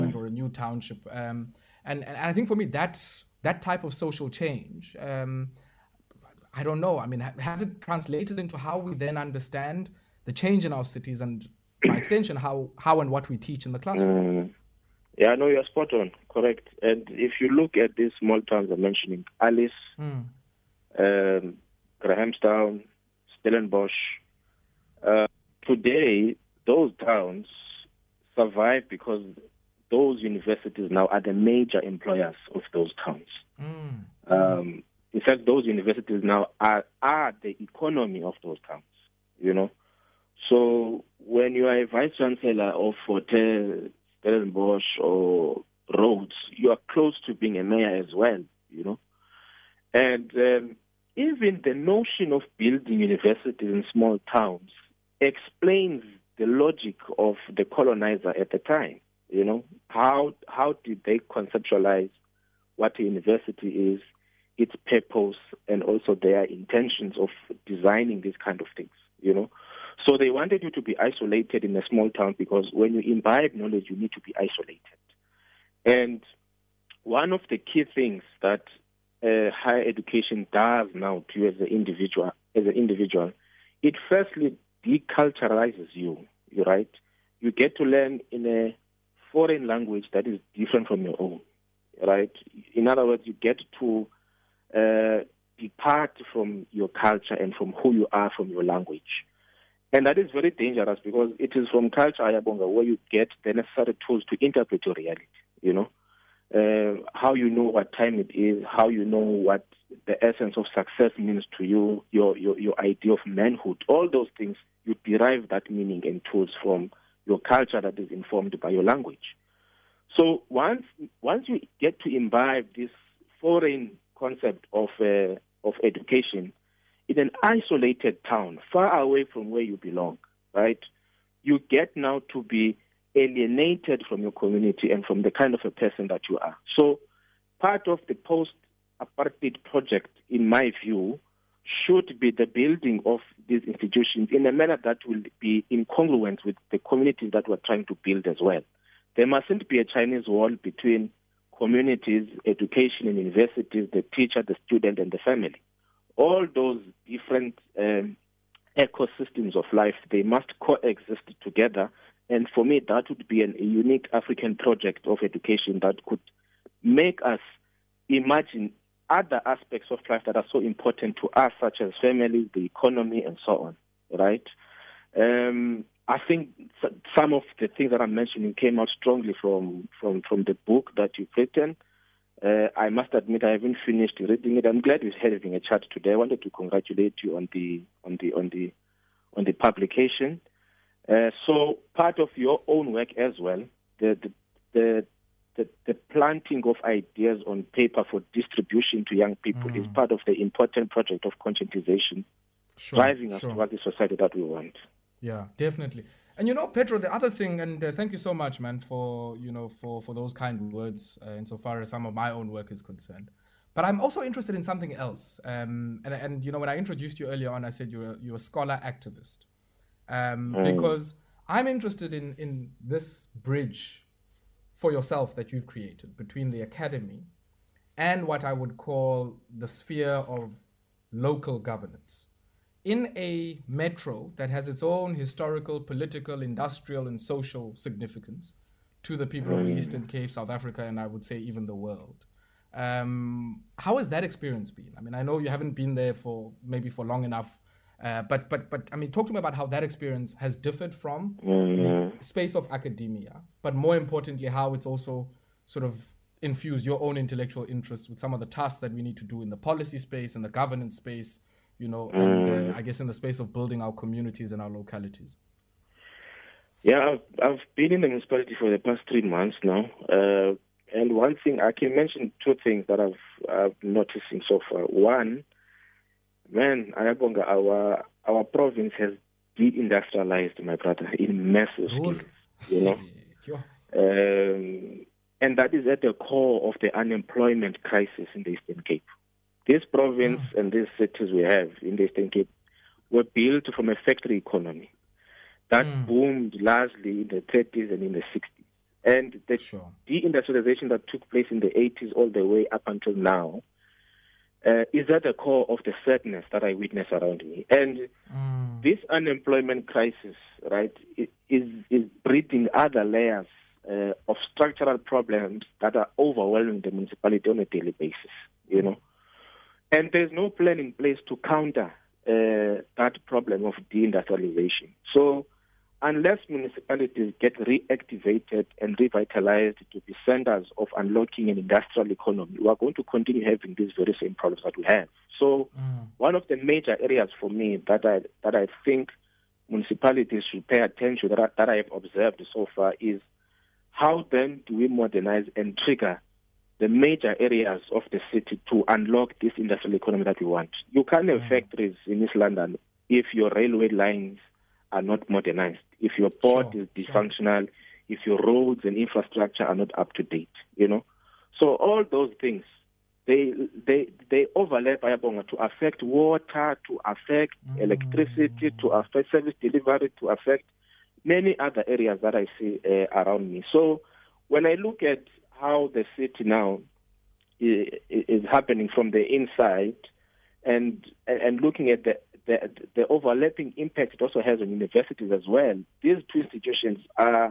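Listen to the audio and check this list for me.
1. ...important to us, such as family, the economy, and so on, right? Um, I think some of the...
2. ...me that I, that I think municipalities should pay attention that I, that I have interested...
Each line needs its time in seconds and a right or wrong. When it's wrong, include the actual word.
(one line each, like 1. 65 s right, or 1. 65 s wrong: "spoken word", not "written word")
1. 170 s right
2. 337 s wrong: "observed", not "interested".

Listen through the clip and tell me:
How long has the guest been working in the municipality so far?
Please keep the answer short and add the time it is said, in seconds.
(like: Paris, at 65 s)
Three months, at 269 s.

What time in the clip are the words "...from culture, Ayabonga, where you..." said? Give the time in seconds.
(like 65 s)
101 s.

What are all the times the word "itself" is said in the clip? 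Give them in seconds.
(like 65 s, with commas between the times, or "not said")
not said.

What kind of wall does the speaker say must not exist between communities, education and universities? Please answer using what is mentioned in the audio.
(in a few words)
Chinese wall.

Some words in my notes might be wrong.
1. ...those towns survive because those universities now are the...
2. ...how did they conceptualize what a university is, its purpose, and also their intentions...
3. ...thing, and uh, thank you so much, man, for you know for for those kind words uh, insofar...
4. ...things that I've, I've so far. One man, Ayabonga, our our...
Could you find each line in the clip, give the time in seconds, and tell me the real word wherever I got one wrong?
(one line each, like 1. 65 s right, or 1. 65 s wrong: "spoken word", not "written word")
1. 26 s right
2. 60 s right
3. 207 s right
4. 272 s right.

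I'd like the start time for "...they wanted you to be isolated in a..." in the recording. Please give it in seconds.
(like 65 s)
70 s.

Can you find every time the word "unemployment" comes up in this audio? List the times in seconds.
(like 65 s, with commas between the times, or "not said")
286 s, 309 s.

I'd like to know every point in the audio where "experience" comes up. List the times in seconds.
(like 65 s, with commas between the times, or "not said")
244 s, 249 s.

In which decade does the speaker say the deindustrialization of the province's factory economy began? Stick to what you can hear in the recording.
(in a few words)
The 80s.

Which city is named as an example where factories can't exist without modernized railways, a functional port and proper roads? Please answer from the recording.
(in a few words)
East London.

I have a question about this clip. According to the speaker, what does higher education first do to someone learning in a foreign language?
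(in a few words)
Deculturalizes you.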